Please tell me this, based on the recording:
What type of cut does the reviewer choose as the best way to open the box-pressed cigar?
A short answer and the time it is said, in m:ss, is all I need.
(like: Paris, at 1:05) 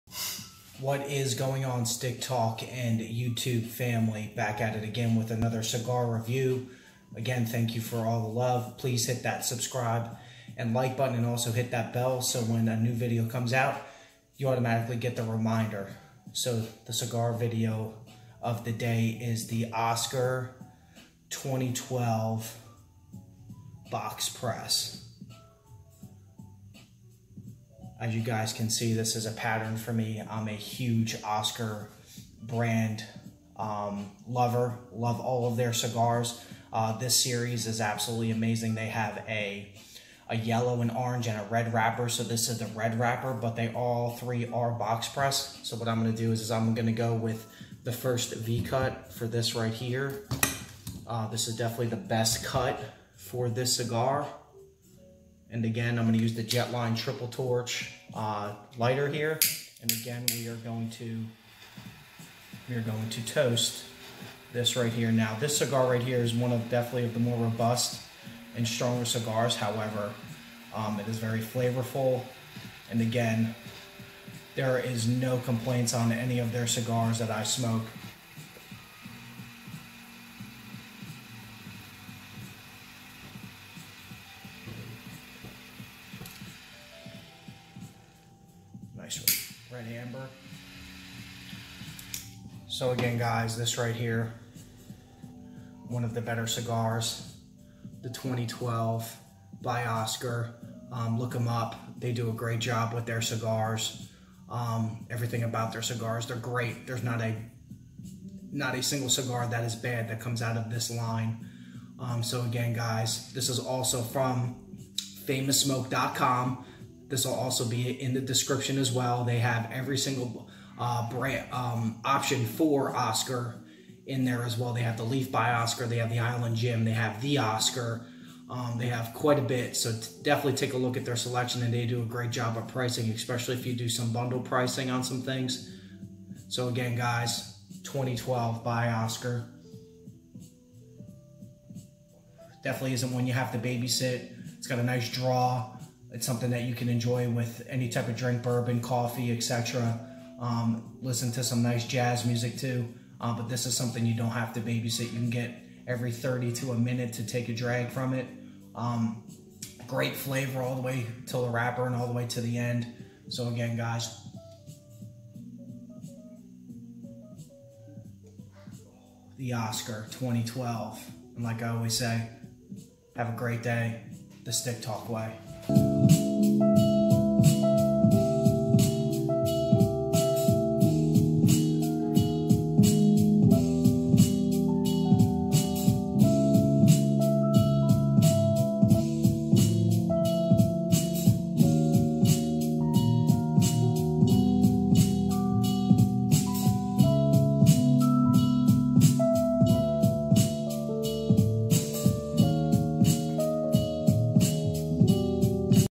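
V cut, at 0:48.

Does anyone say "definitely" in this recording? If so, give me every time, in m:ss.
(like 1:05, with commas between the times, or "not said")
0:51, 1:06, 2:10, 2:22.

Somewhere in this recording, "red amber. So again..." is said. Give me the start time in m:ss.
1:29.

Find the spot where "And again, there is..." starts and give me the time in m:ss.
1:12.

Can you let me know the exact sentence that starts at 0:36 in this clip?
Uh, this series is absolutely amazing.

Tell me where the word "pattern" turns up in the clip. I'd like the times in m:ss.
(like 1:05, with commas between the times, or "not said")
0:29.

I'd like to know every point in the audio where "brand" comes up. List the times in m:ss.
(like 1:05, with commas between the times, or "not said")
0:32, 2:01.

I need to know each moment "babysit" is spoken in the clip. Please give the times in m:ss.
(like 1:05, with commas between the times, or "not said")
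2:23, 2:34.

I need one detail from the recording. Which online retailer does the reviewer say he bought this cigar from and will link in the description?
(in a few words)
FamousSmoke.com.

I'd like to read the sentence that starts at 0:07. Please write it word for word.
Again, thank you for all the love.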